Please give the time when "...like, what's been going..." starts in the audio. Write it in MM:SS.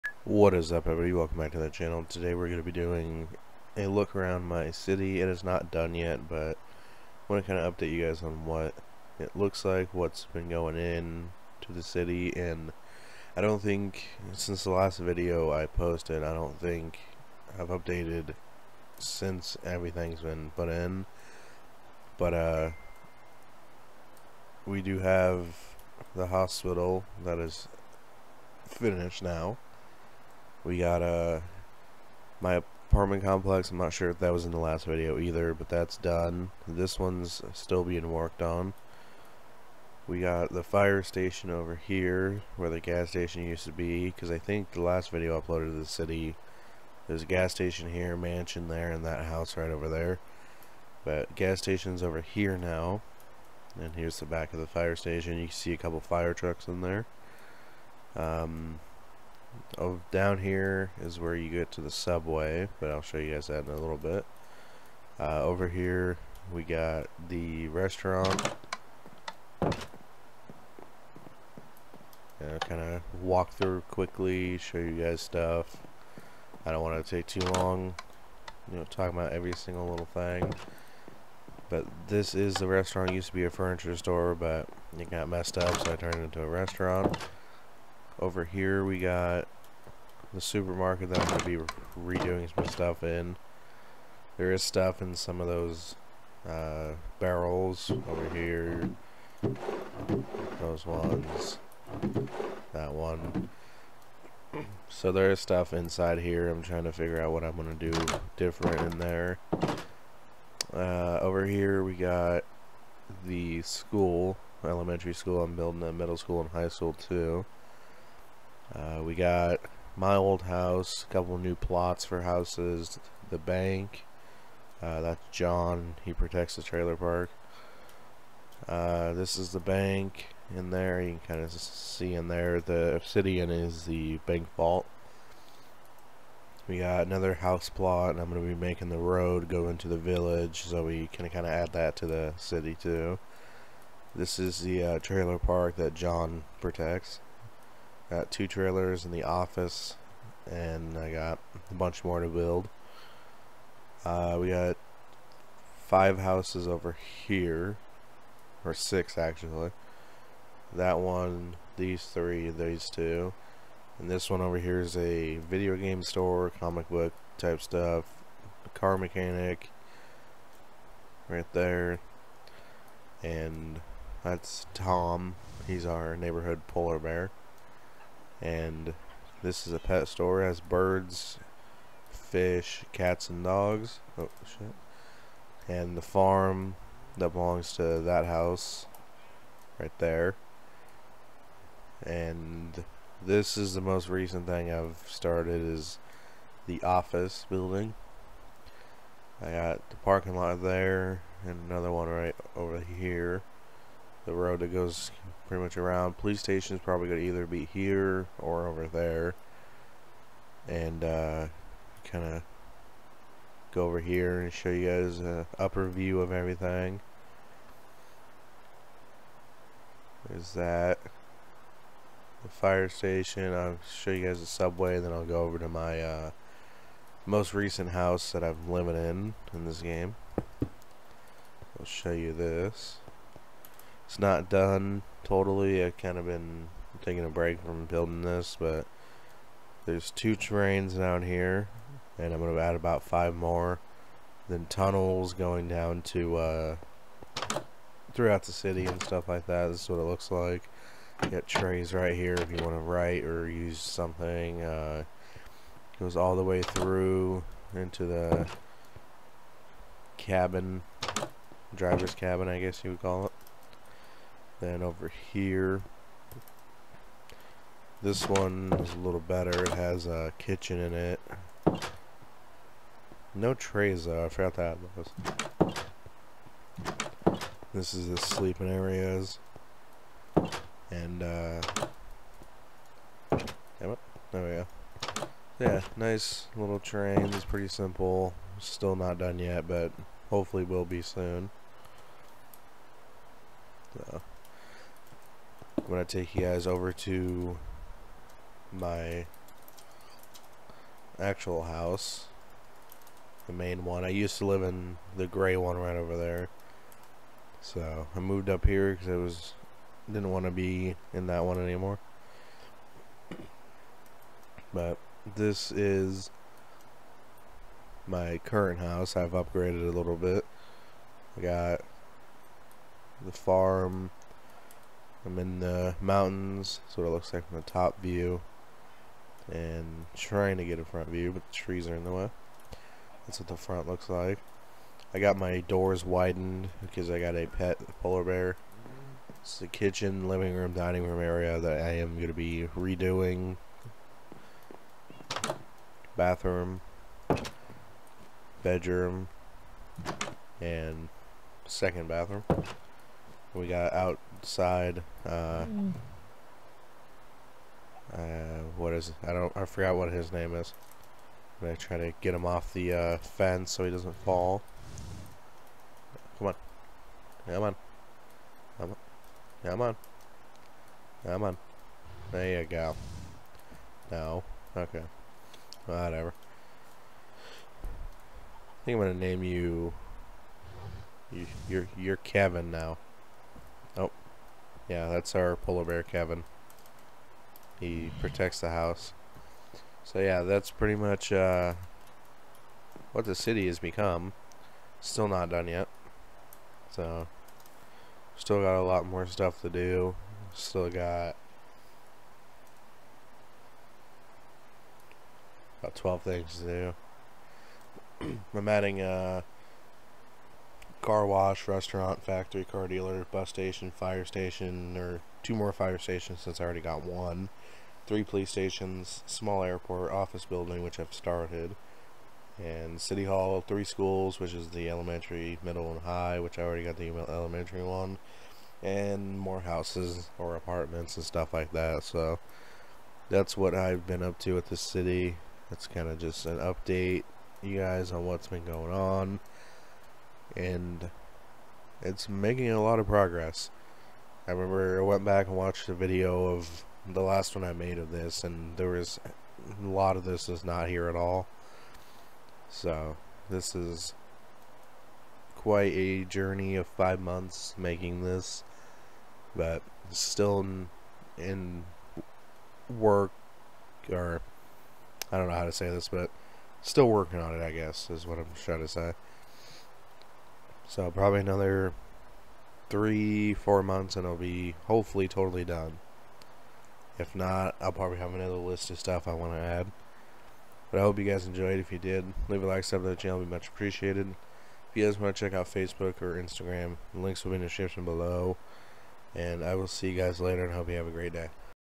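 00:09.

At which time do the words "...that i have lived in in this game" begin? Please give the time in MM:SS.
03:48.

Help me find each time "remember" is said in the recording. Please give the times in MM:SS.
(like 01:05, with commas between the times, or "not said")
07:24.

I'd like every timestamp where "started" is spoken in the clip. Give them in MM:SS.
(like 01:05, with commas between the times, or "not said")
03:15, 07:01.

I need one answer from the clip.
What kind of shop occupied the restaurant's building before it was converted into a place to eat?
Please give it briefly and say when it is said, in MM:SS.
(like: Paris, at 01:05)
furniture store, at 01:23.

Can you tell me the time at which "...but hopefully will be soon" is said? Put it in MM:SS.
04:49.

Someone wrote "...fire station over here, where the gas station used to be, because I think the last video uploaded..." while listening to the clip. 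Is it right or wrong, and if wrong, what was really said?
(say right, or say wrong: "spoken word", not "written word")
right.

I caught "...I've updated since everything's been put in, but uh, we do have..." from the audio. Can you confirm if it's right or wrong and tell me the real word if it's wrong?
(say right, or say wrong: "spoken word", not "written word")
right.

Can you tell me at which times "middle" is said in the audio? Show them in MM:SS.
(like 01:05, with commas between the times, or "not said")
01:55, 07:05.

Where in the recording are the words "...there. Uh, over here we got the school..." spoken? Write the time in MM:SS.
01:48.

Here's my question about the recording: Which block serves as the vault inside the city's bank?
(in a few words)
obsidian.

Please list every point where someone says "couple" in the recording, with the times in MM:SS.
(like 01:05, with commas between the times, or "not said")
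00:55, 02:01.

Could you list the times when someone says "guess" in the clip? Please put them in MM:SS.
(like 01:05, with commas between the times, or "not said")
04:22, 07:47.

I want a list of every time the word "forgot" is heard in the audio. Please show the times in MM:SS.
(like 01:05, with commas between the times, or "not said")
04:34, 05:59.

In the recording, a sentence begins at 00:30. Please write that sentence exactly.
We got uh, my apartment complex.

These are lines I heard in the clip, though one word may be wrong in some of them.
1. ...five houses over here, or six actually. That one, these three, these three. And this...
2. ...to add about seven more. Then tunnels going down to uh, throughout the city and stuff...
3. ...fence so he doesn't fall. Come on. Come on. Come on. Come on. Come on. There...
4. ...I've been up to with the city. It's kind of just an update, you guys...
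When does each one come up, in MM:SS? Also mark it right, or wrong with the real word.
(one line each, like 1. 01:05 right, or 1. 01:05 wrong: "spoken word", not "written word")
1. 02:35 wrong: "two", not "three"
2. 04:02 wrong: "five", not "seven"
3. 06:03 right
4. 07:13 right.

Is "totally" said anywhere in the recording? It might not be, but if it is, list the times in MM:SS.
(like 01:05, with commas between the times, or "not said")
03:55, 07:55.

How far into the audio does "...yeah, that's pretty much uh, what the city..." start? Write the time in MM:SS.
06:30.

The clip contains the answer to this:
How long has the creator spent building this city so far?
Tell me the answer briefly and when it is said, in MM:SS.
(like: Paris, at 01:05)
5 months, at 07:36.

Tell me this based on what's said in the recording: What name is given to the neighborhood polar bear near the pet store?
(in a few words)
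Tom.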